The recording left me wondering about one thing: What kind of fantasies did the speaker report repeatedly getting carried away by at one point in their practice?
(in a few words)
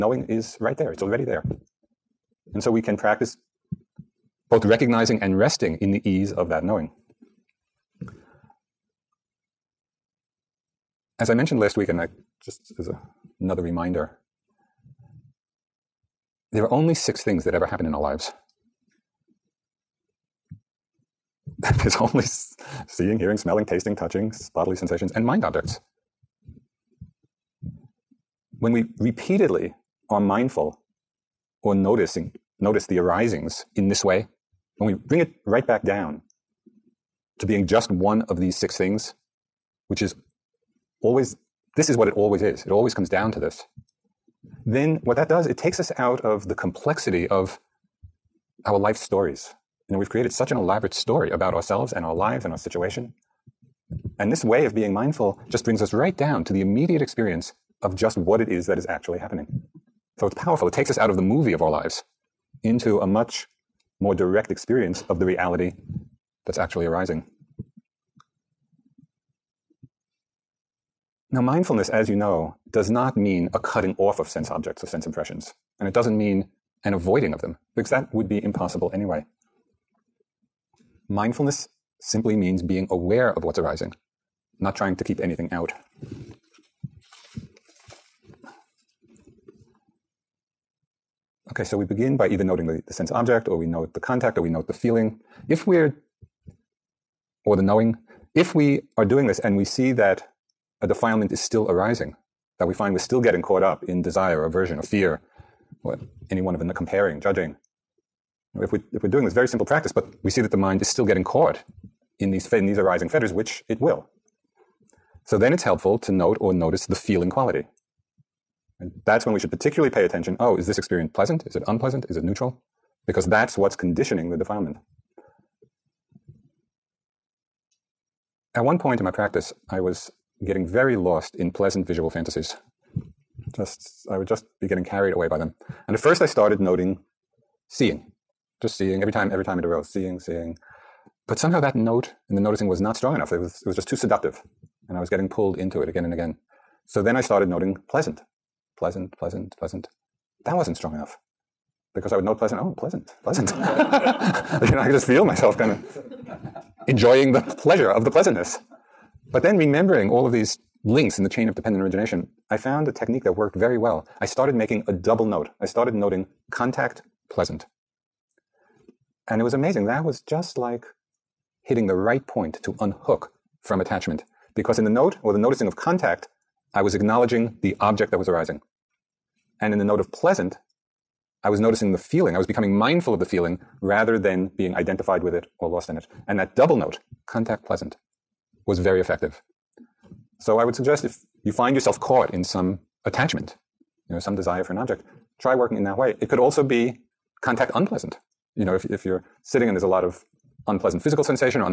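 pleasant visual fantasies.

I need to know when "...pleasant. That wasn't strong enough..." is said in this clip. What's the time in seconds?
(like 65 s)
149 s.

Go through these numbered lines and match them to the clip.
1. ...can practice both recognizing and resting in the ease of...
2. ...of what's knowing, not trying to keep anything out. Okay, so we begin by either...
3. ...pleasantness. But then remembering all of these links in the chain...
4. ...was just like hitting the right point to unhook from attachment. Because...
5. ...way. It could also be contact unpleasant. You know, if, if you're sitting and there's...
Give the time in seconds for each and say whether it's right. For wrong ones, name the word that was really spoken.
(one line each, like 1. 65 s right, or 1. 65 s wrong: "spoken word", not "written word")
1. 2 s right
2. 83 s wrong: "arising", not "knowing"
3. 158 s right
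4. 170 s right
5. 195 s right.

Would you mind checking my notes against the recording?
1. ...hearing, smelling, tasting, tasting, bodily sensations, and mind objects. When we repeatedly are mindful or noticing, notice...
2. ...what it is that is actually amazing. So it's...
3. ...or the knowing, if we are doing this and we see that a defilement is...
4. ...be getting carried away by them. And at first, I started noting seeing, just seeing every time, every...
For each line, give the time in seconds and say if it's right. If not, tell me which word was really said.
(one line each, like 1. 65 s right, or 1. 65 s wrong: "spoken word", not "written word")
1. 23 s wrong: "touching", not "tasting"
2. 58 s wrong: "happening", not "amazing"
3. 97 s right
4. 134 s right.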